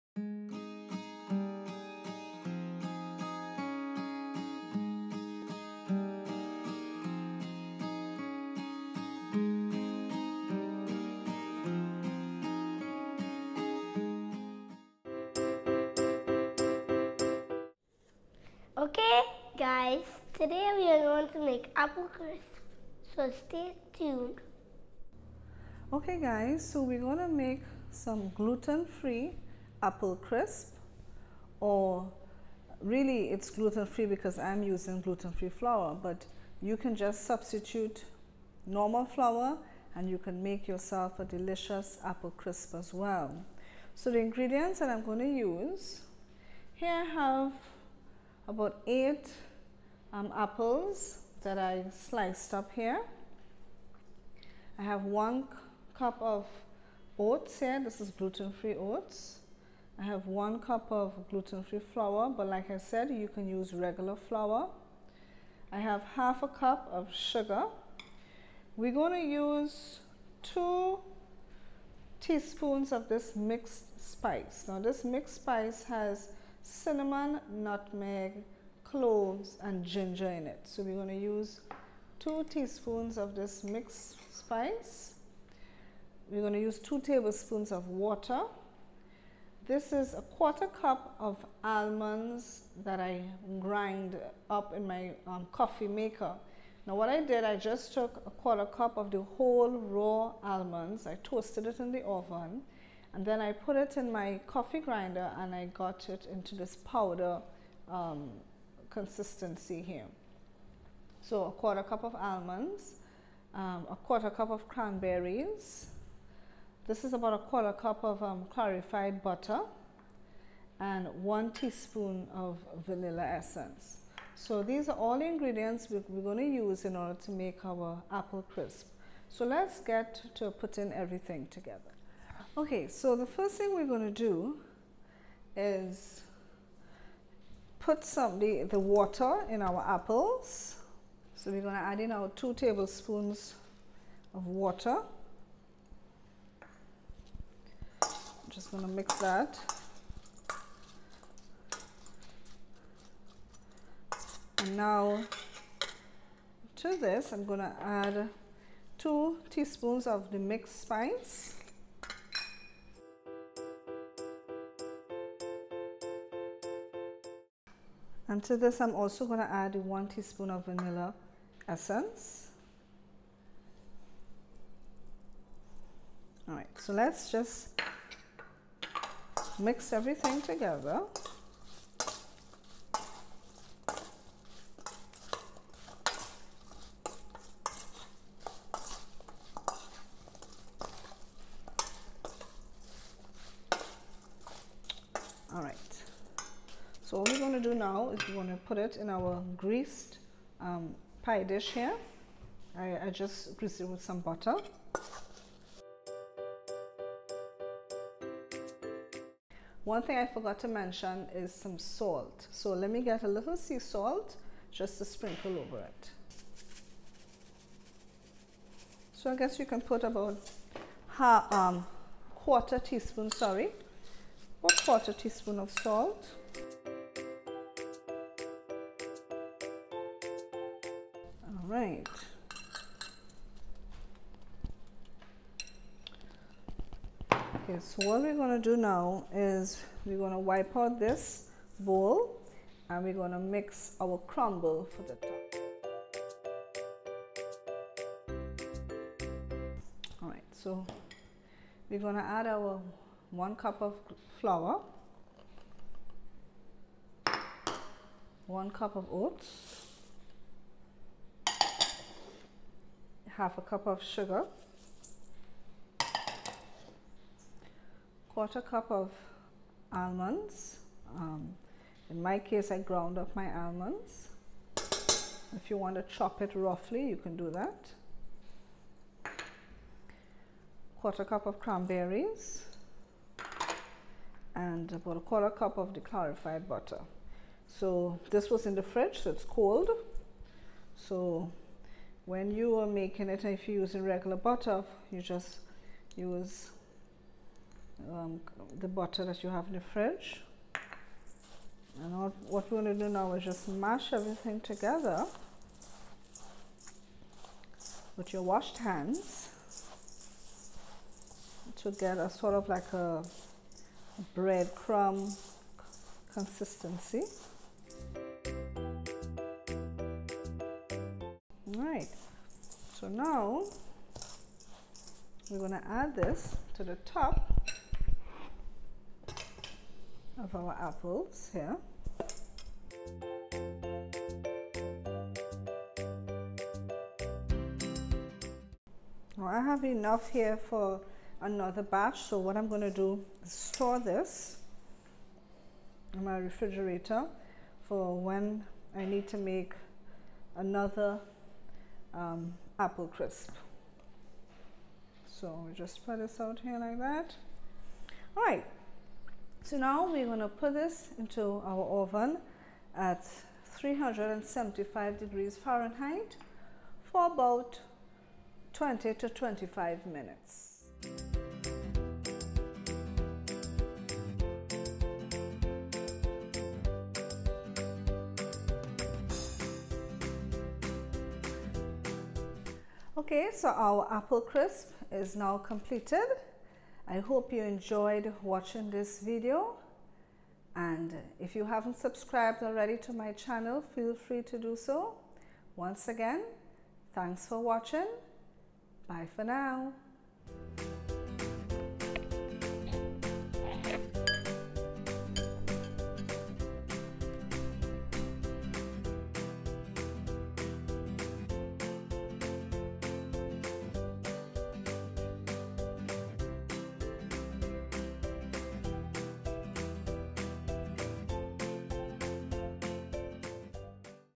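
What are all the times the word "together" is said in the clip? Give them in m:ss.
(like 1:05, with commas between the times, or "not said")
2:11, 3:00, 5:04.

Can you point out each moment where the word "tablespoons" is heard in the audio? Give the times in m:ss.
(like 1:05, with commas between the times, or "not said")
1:27, 2:22.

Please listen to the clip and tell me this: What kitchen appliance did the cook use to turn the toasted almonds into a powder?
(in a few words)
coffee grinder.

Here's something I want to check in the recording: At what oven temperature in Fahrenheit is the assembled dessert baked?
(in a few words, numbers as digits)
375 degrees.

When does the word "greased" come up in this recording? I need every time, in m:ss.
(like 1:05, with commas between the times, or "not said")
3:19, 3:23.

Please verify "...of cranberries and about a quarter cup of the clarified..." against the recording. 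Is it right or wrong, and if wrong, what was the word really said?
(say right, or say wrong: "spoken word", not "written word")
right.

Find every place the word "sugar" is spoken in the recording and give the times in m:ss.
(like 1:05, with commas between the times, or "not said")
1:07, 4:24.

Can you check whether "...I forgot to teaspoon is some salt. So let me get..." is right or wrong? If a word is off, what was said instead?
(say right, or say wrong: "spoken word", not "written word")
wrong: "mention", not "teaspoon".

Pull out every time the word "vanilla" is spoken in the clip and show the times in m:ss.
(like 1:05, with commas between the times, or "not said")
2:02, 2:50.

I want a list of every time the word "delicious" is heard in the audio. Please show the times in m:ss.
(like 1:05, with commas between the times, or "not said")
0:41.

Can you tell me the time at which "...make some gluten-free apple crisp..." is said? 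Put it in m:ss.
0:27.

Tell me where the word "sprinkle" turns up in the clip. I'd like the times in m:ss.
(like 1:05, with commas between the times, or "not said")
3:35.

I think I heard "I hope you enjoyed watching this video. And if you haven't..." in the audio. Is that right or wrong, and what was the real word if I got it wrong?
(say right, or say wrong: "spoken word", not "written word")
right.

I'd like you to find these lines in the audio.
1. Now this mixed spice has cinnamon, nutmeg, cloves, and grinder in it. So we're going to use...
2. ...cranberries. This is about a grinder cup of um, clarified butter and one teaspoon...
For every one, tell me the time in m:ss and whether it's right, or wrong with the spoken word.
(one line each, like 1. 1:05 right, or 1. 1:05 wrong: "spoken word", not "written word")
1. 1:14 wrong: "ginger", not "grinder"
2. 1:54 wrong: "quarter", not "grinder".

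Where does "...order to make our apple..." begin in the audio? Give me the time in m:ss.
2:06.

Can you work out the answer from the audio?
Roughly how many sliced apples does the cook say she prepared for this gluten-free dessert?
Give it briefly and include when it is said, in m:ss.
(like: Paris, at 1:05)
8, at 0:48.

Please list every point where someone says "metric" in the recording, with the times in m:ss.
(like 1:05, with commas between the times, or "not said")
not said.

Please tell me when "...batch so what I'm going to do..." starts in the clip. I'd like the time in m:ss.
5:41.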